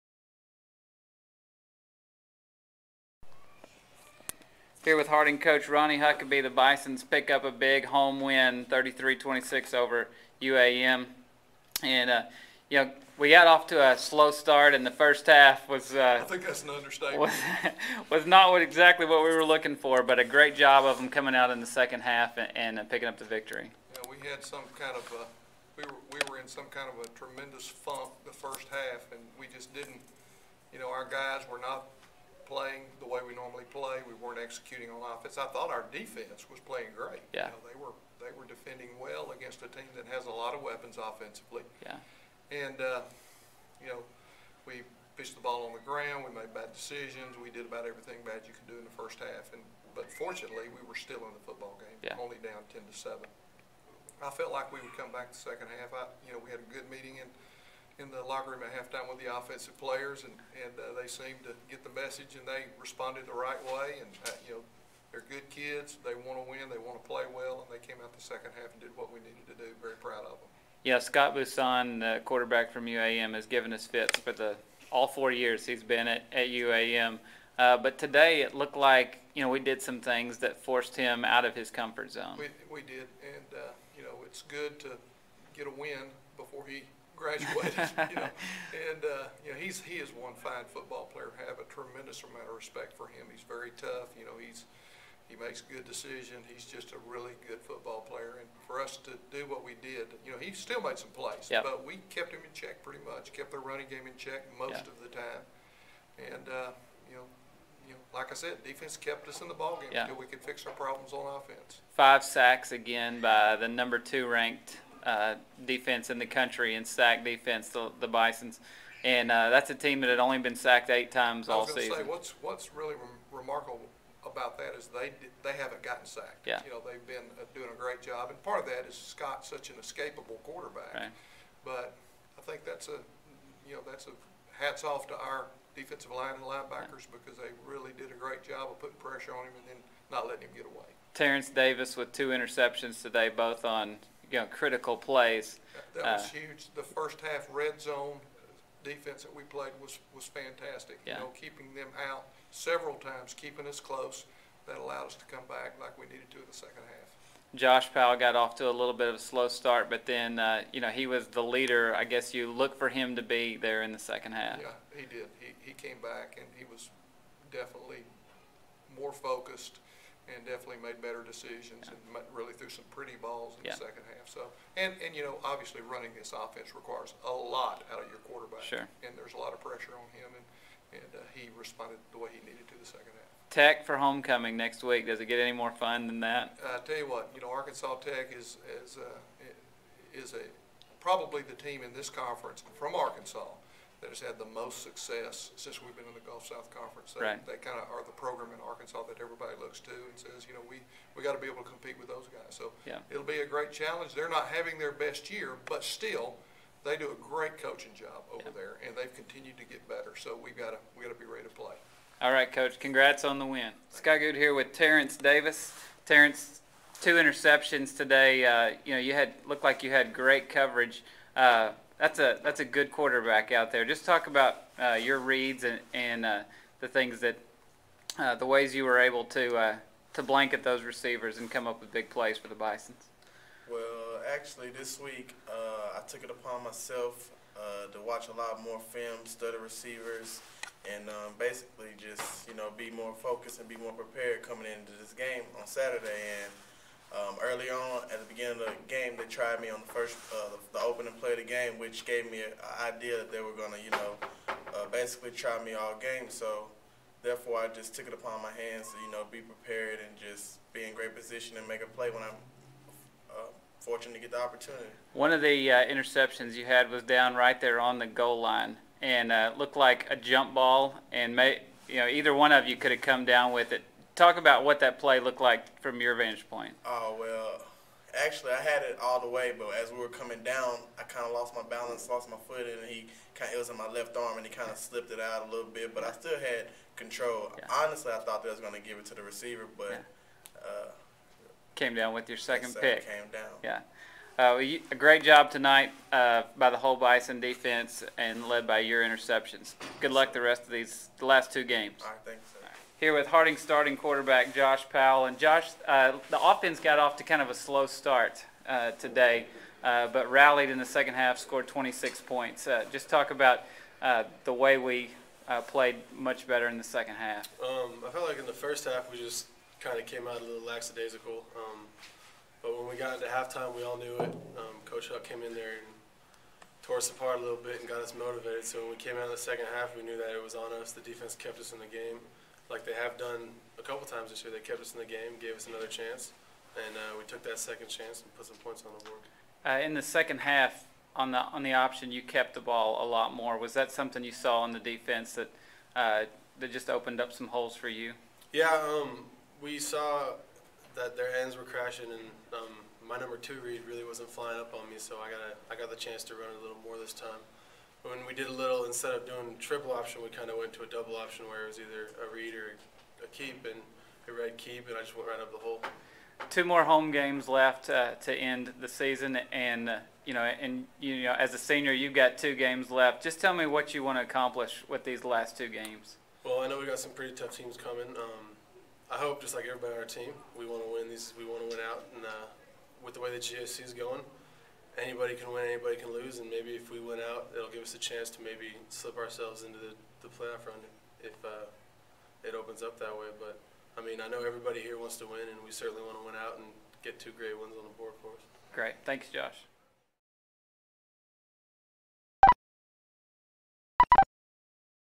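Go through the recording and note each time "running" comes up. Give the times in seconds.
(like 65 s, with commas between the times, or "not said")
103 s, 175 s.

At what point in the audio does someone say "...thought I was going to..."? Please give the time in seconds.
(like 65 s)
288 s.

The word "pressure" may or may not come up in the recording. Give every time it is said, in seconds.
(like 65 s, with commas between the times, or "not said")
138 s, 179 s.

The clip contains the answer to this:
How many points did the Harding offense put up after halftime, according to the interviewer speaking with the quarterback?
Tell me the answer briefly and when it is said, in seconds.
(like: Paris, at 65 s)
26, at 311 s.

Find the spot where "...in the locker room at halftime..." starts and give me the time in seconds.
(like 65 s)
58 s.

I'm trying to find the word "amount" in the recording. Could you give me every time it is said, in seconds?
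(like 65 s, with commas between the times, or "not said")
92 s.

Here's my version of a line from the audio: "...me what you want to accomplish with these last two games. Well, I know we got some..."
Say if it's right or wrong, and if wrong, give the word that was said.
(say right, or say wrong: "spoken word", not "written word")
right.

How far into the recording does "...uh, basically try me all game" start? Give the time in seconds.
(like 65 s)
254 s.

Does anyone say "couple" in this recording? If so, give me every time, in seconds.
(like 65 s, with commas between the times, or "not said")
333 s.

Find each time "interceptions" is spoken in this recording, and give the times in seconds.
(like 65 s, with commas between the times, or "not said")
142 s, 217 s, 265 s, 299 s.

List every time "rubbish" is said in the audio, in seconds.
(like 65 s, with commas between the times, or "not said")
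not said.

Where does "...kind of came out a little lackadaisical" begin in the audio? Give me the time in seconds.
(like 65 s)
319 s.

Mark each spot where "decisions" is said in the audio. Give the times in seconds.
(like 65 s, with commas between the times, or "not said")
46 s, 95 s, 171 s.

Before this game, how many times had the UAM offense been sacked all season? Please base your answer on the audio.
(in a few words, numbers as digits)
8.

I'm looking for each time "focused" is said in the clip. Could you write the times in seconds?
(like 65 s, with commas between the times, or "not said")
169 s, 243 s.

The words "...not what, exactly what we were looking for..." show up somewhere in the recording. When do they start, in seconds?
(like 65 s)
18 s.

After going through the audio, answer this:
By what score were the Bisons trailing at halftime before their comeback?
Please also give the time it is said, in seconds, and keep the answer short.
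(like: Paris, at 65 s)
10 to 7, at 52 s.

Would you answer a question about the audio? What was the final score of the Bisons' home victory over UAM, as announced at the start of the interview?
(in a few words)
33-26.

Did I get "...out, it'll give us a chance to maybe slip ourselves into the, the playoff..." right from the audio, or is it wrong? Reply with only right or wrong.
right.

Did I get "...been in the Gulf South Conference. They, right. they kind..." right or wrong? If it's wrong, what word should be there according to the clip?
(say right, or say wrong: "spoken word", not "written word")
right.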